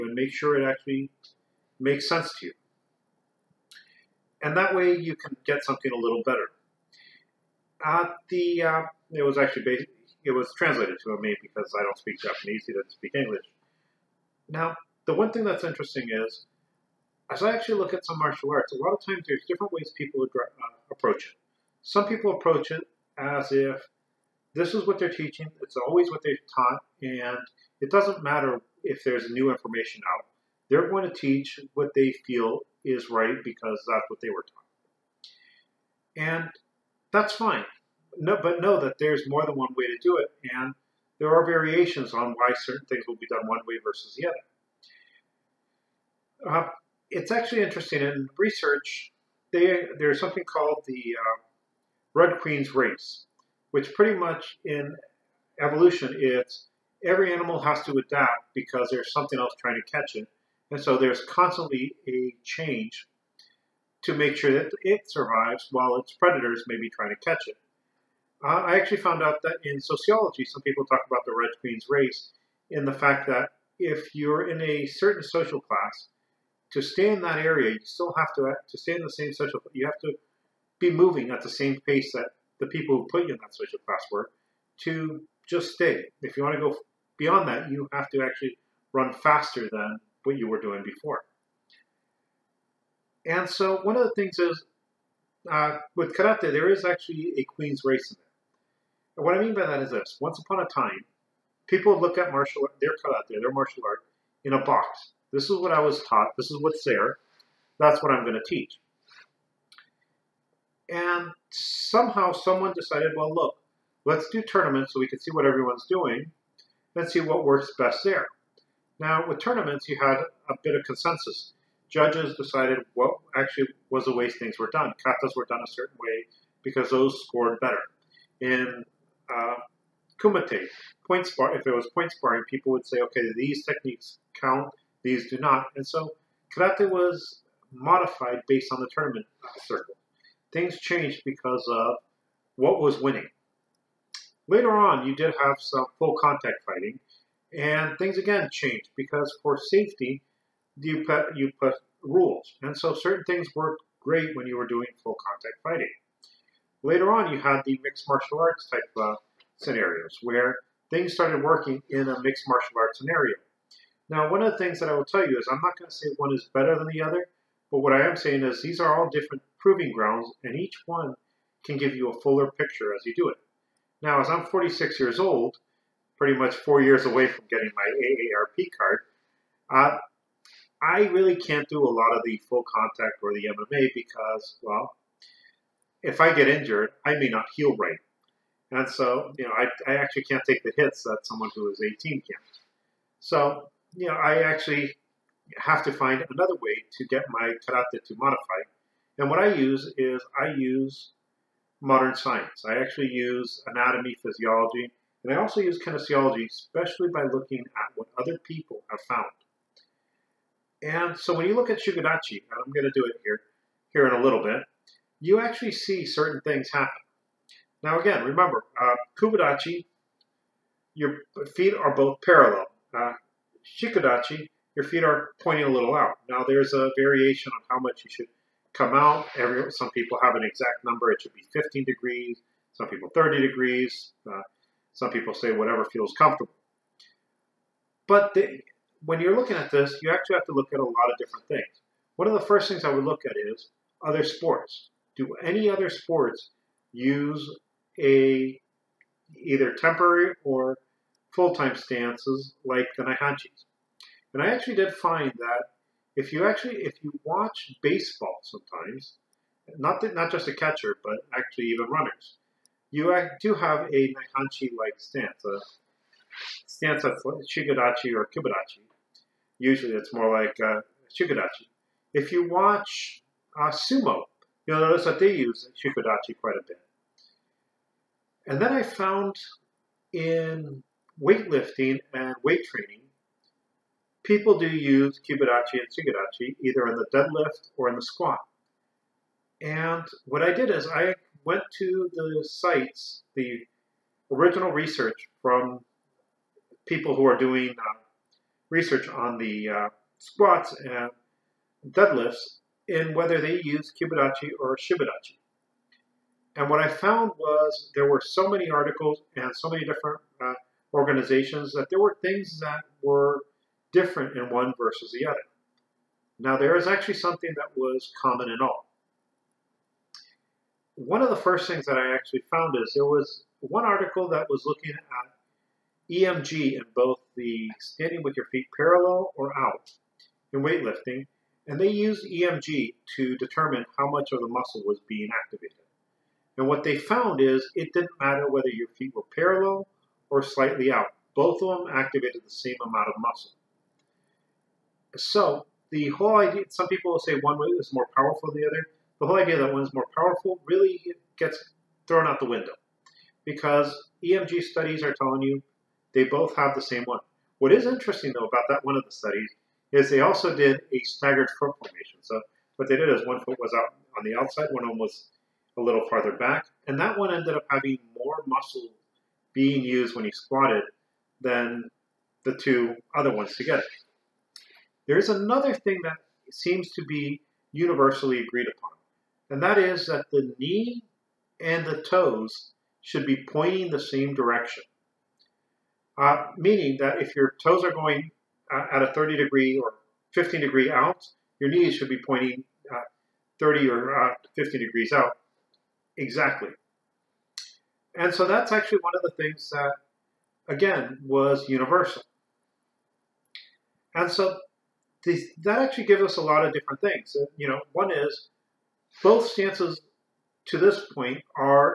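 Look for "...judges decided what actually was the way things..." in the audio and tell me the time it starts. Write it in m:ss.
2:01.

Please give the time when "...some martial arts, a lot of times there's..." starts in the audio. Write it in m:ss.
0:18.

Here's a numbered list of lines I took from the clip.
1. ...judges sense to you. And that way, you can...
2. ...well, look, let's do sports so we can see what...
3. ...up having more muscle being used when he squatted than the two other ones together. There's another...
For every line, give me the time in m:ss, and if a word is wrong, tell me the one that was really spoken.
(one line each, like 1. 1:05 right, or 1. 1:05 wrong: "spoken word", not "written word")
1. 0:01 wrong: "makes", not "judges"
2. 1:53 wrong: "tournaments", not "sports"
3. 6:07 right.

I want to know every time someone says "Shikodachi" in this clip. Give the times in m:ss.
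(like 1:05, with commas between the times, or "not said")
3:31, 3:43, 4:35, 4:45, 5:04.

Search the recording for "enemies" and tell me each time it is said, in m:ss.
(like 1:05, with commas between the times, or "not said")
not said.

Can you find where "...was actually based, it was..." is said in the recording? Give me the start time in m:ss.
0:09.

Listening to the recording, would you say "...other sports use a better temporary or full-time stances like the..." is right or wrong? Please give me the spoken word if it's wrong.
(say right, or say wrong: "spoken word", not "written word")
wrong: "either", not "better".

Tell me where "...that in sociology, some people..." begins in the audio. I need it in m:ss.
1:09.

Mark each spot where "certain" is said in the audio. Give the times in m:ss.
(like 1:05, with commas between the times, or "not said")
0:42, 1:14, 2:05, 2:32, 3:36.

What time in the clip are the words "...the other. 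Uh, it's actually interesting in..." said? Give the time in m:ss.
0:44.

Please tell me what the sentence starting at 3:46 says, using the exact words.
Now there's a variation on how much you should come out.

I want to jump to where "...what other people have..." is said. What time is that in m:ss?
3:27.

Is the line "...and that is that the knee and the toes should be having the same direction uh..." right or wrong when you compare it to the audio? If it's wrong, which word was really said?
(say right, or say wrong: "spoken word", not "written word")
wrong: "pointing", not "having".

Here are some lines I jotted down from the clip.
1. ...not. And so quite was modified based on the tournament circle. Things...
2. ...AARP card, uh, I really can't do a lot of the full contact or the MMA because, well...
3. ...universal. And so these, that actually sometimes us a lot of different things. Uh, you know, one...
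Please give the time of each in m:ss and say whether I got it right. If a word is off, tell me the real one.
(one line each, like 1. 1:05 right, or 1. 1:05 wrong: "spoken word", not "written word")
1. 2:15 wrong: "karate", not "quite"
2. 2:57 right
3. 6:41 wrong: "gives", not "sometimes".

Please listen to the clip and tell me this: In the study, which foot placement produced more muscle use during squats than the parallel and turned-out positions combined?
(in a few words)
Staggered foot formation.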